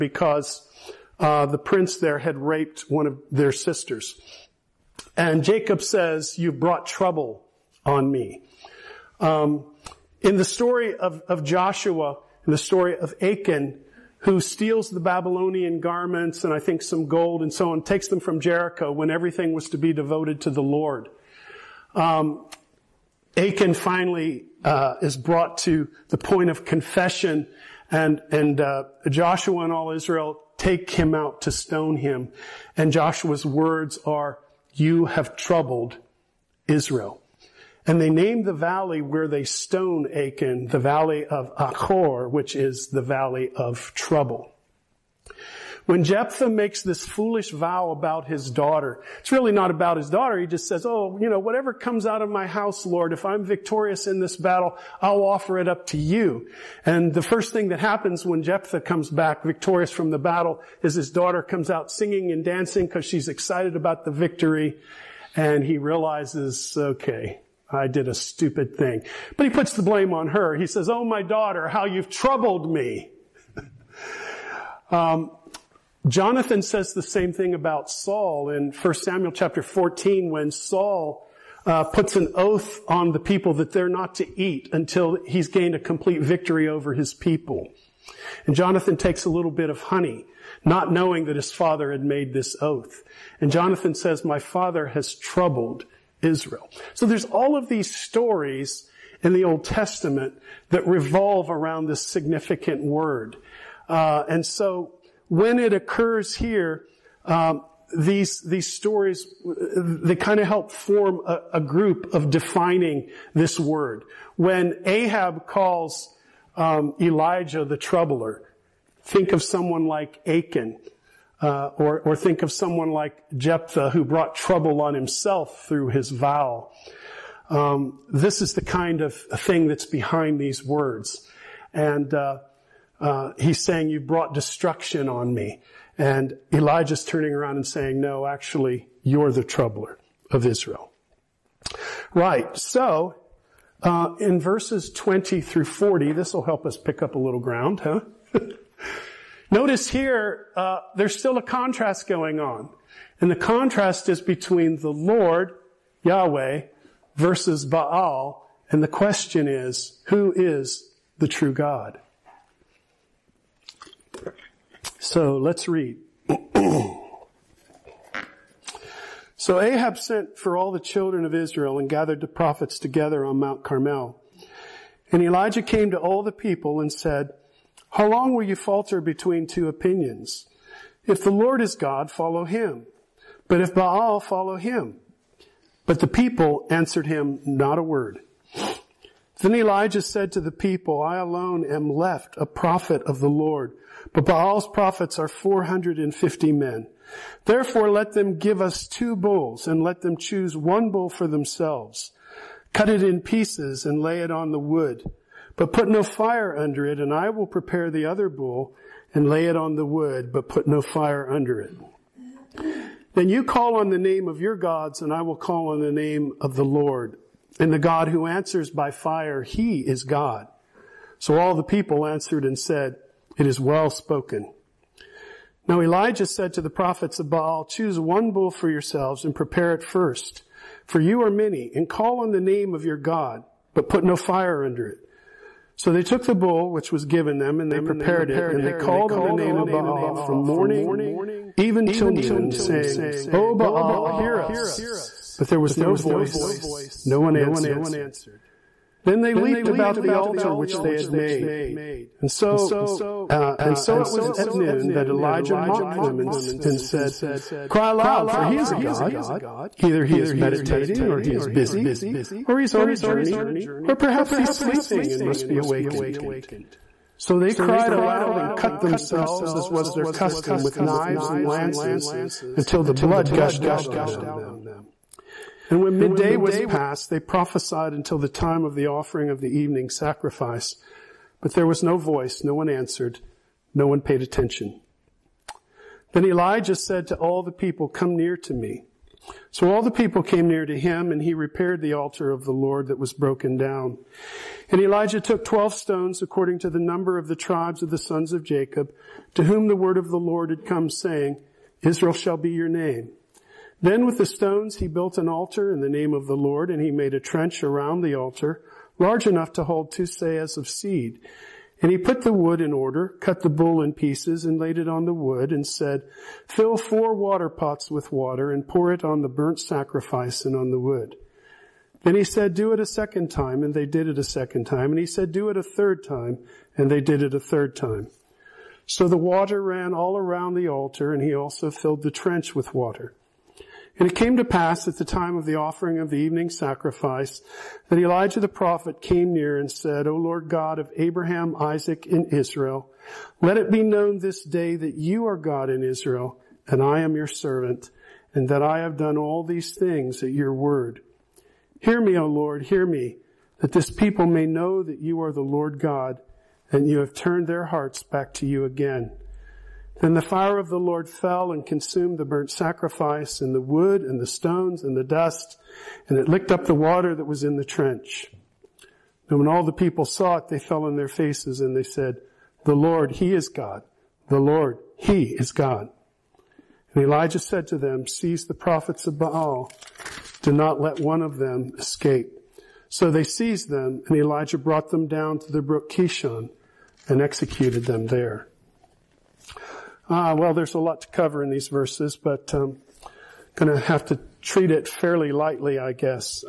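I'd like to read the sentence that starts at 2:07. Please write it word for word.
Um, this is the kind of thing that's behind these words.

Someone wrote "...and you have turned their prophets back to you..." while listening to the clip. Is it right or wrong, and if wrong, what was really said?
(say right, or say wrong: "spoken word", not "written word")
wrong: "hearts", not "prophets".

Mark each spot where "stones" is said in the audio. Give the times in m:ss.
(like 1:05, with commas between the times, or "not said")
0:31, 0:39, 4:55, 5:04, 6:04.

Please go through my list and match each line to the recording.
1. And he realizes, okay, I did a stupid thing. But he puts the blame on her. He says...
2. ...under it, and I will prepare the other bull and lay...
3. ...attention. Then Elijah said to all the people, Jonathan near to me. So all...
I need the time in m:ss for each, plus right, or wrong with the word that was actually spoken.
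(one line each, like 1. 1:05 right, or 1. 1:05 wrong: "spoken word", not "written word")
1. 1:05 right
2. 3:26 right
3. 4:44 wrong: "Come", not "Jonathan".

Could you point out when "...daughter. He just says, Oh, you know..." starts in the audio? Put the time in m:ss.
0:50.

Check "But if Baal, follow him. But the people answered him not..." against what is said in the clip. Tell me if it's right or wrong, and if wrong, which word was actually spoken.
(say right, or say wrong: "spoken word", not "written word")
right.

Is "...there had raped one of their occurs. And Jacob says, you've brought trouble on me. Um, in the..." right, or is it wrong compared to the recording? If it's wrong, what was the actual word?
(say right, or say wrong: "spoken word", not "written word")
wrong: "sisters", not "occurs".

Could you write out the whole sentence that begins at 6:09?
And when all the people saw it, they fell on their faces and they said, The Lord, He is God.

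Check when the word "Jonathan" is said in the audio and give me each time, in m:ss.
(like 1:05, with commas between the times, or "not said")
1:16, 1:28, 1:33.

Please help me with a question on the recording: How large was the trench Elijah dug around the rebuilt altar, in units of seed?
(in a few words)
Two seahs.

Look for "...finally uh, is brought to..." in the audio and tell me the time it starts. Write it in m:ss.
0:23.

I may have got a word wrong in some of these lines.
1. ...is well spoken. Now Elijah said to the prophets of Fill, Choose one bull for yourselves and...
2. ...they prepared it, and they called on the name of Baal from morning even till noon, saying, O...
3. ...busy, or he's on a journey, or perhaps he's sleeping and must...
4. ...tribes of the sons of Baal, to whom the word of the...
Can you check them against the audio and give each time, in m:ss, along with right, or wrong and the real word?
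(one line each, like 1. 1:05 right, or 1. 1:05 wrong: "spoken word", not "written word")
1. 3:43 wrong: "Baal", not "Fill"
2. 3:57 right
3. 4:21 right
4. 4:57 wrong: "Jacob", not "Baal".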